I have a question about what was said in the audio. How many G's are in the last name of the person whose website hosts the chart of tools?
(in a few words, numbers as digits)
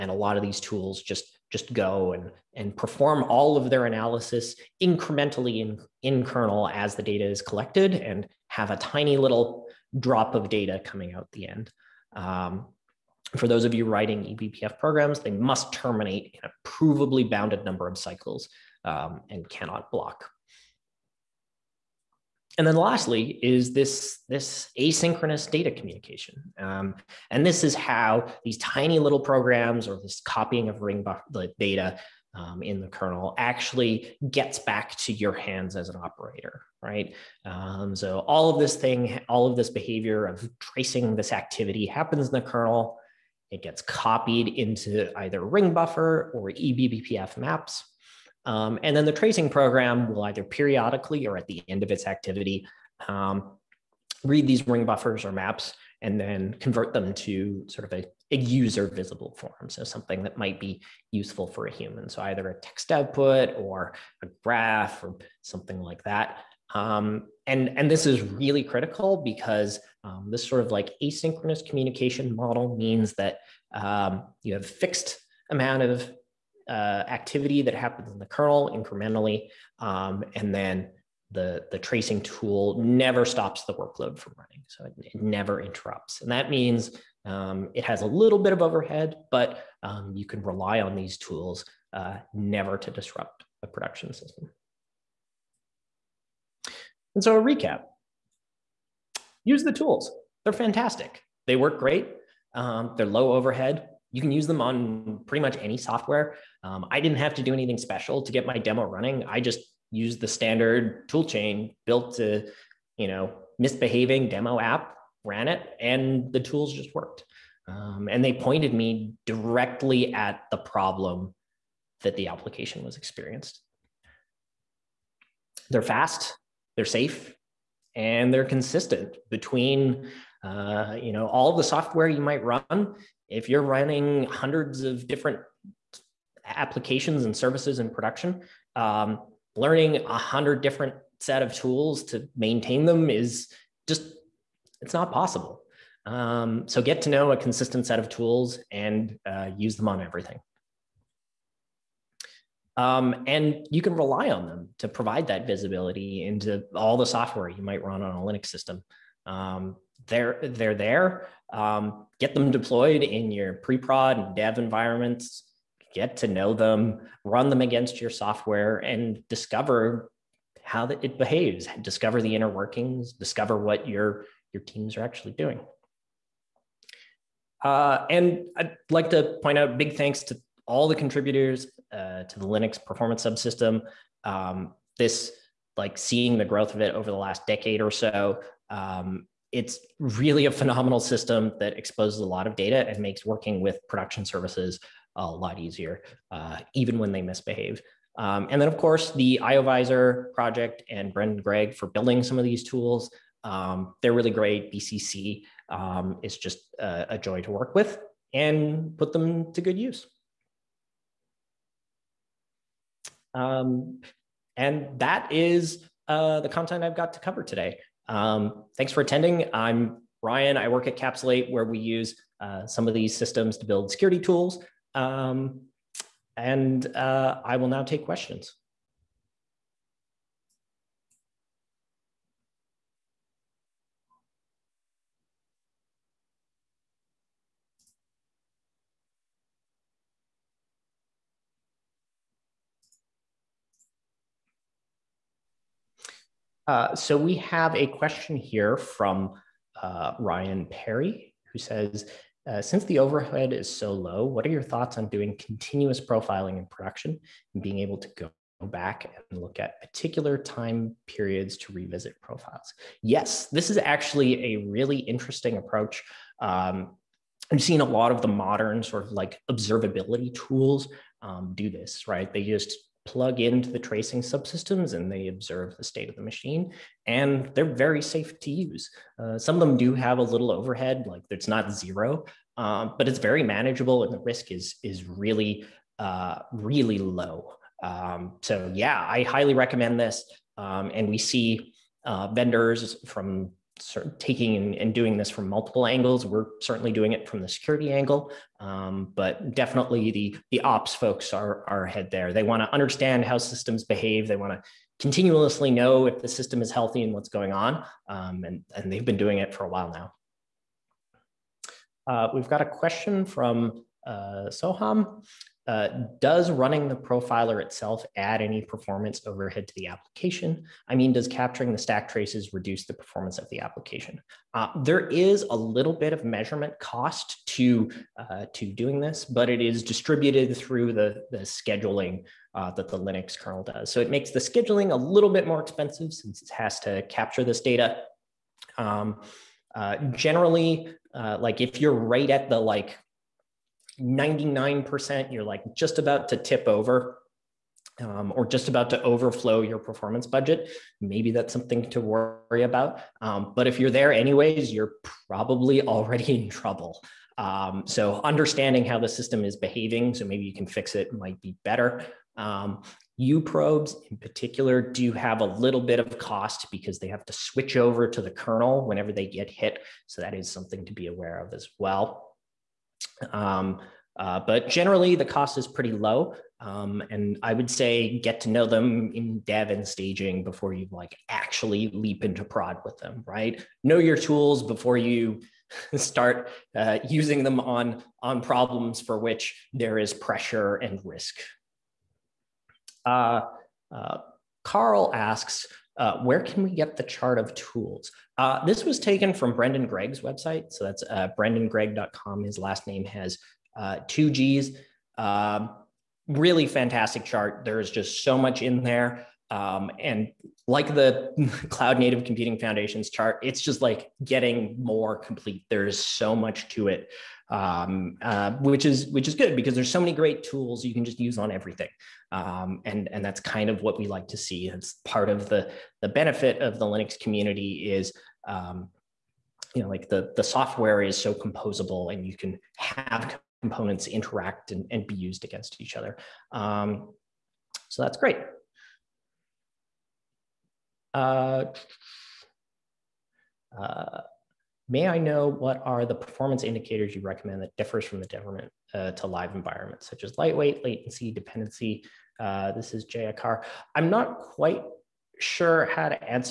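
2.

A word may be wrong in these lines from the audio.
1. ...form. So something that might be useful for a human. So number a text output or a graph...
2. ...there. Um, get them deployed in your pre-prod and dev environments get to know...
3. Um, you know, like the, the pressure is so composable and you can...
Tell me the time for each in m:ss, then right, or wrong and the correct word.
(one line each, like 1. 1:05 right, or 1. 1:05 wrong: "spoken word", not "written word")
1. 0:59 wrong: "either", not "number"
2. 2:40 right
3. 7:08 wrong: "software", not "pressure".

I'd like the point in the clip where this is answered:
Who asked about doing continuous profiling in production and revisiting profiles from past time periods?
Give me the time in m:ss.
4:10.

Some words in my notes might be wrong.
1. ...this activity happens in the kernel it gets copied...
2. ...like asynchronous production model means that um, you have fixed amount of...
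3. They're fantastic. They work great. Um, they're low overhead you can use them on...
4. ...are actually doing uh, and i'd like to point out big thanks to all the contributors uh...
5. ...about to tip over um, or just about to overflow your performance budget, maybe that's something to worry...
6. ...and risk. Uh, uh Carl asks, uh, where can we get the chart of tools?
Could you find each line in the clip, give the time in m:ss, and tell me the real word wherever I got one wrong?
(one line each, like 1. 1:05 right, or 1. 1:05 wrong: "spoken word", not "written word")
1. 0:41 right
2. 1:10 wrong: "communication", not "production"
3. 1:40 right
4. 2:54 right
5. 5:45 right
6. 6:30 right.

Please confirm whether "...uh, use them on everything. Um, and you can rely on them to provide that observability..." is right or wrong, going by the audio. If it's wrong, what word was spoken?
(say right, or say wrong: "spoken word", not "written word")
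wrong: "visibility", not "observability".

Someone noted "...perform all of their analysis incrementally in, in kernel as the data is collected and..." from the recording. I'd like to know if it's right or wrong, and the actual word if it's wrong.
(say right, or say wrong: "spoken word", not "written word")
right.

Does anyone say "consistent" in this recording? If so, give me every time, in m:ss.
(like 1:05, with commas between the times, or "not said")
2:08, 2:27.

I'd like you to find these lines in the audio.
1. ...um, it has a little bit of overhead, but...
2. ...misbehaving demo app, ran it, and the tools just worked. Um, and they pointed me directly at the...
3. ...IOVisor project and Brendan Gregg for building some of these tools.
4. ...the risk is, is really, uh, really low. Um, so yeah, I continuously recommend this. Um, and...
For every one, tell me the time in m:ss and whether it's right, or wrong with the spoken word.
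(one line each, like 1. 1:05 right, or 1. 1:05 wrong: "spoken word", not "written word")
1. 1:27 right
2. 1:53 right
3. 3:19 right
4. 4:44 wrong: "highly", not "continuously".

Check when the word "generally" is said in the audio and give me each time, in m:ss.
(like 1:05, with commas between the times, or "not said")
5:40, 6:14.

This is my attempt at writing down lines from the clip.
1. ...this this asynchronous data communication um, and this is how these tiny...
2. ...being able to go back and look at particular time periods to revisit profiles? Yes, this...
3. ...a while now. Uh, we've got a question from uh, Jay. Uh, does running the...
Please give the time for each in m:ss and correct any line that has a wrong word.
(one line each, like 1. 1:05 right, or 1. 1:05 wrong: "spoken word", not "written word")
1. 0:23 right
2. 4:17 right
3. 5:09 wrong: "Soham", not "Jay".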